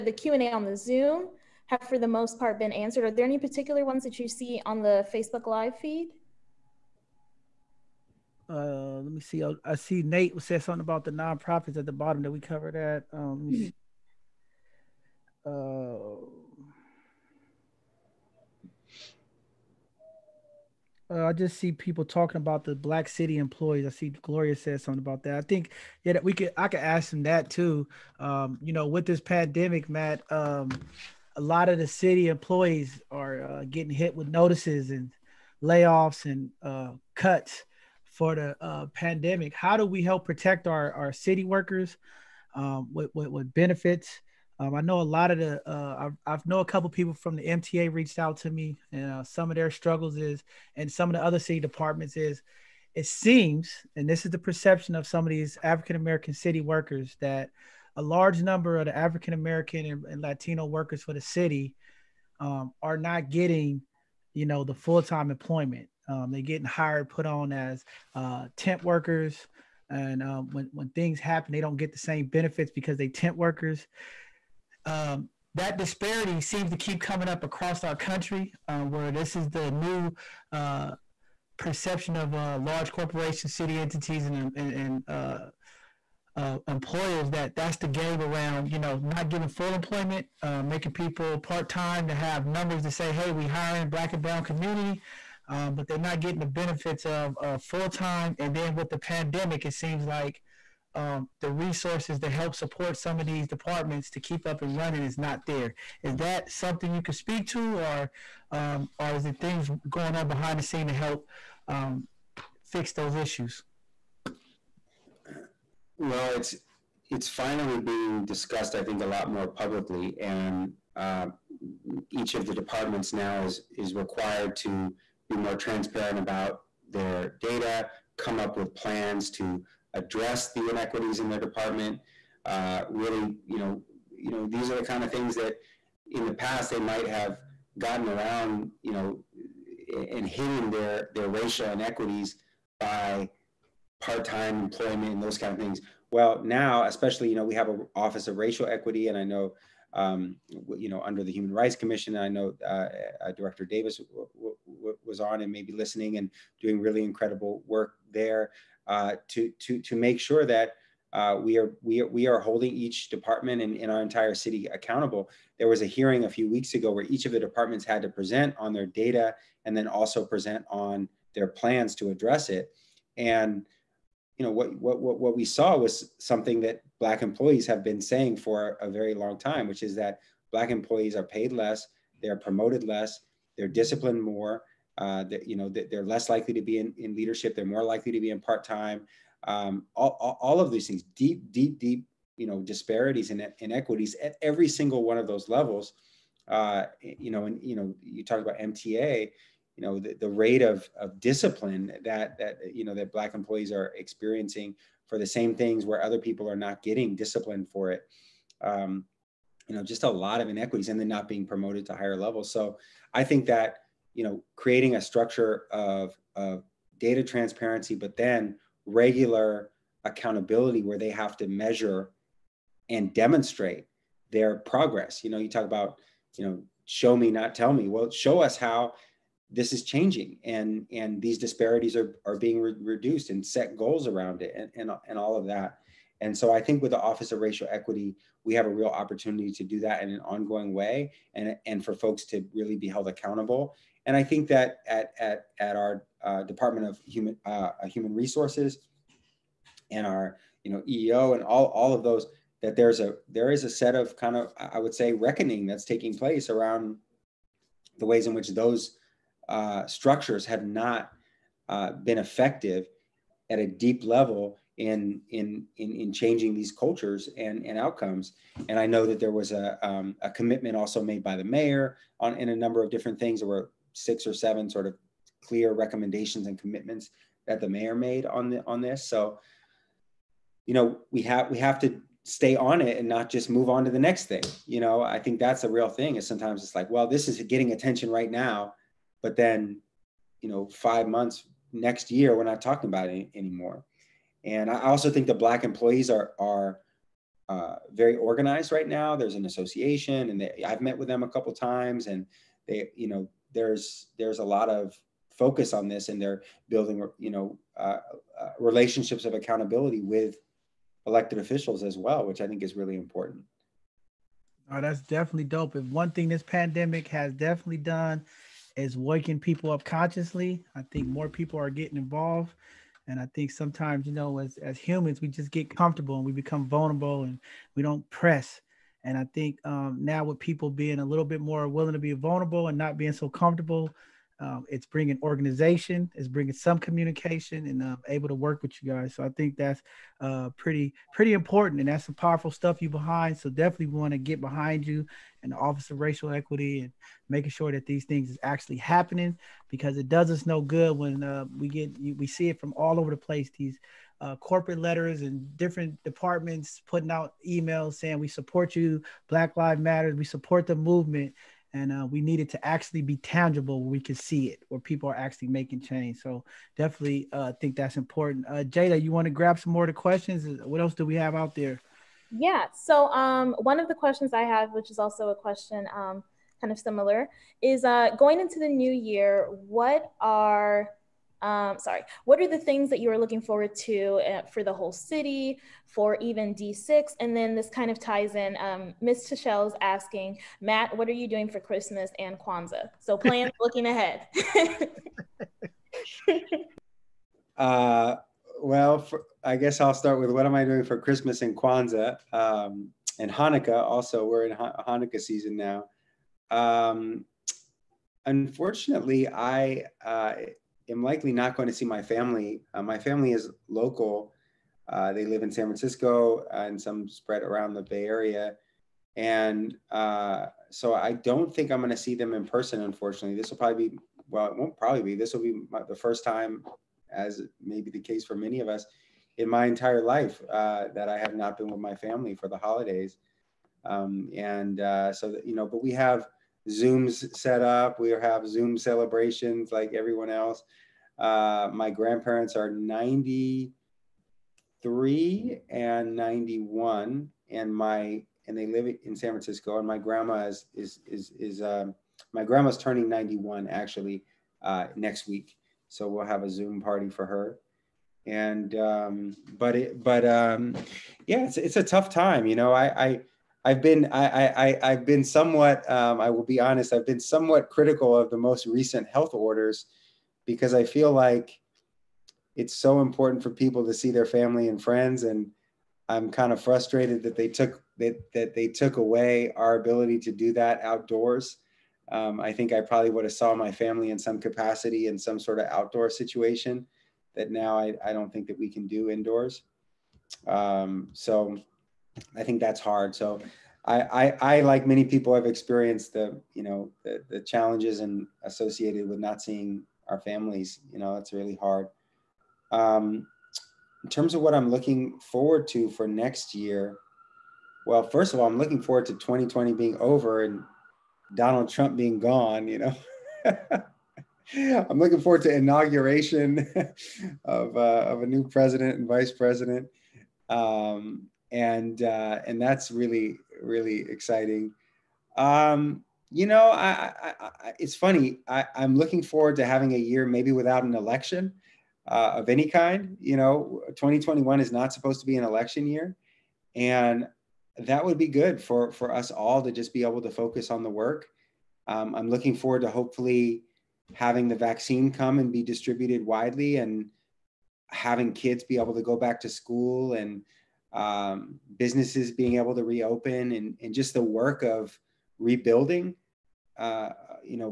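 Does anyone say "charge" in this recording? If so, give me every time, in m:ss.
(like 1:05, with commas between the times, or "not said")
not said.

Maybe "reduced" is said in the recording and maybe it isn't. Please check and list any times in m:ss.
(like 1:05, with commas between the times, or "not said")
3:52.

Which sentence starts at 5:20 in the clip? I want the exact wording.
I think more people are getting involved.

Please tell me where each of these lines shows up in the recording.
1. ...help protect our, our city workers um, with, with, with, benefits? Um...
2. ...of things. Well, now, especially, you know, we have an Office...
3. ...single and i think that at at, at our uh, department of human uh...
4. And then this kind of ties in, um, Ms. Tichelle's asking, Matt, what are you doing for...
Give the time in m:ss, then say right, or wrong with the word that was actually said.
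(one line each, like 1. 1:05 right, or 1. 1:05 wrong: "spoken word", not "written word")
1. 0:40 right
2. 2:25 right
3. 4:03 wrong: "accountable", not "single"
4. 6:27 right.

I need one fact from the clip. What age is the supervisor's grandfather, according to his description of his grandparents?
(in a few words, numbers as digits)
93.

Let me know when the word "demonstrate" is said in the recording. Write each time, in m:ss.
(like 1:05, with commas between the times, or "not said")
3:43.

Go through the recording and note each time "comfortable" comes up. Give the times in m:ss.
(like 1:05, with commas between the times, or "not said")
5:25, 5:33.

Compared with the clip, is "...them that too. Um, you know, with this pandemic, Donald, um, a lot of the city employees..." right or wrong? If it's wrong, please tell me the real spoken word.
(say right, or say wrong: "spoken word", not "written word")
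wrong: "Matt", not "Donald".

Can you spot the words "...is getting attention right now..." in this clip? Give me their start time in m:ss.
4:47.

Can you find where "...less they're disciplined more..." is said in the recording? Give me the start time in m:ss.
3:02.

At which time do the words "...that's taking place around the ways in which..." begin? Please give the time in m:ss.
4:15.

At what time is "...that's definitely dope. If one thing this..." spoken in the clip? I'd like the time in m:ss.
5:14.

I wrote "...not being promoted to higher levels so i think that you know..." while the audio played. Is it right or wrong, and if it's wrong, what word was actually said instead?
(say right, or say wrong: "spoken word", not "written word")
right.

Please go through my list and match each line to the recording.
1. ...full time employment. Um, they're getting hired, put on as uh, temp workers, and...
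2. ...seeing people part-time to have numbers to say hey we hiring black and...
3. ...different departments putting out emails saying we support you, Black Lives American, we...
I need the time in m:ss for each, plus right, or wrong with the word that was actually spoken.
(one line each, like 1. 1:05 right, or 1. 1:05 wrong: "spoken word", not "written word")
1. 1:04 right
2. 1:30 wrong: "making", not "seeing"
3. 5:55 wrong: "Matter", not "American".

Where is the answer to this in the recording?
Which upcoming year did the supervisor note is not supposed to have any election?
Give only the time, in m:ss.
8:53.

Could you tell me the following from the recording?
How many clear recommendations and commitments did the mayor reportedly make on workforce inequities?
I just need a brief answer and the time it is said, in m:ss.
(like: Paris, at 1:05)
six or seven, at 4:33.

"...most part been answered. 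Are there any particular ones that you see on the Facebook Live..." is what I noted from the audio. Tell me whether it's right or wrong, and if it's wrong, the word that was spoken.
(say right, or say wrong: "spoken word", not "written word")
right.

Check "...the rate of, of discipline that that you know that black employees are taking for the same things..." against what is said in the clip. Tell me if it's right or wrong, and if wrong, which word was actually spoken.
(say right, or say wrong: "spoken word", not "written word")
wrong: "experiencing", not "taking".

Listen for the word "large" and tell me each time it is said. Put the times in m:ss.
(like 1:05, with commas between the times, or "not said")
0:58, 1:22.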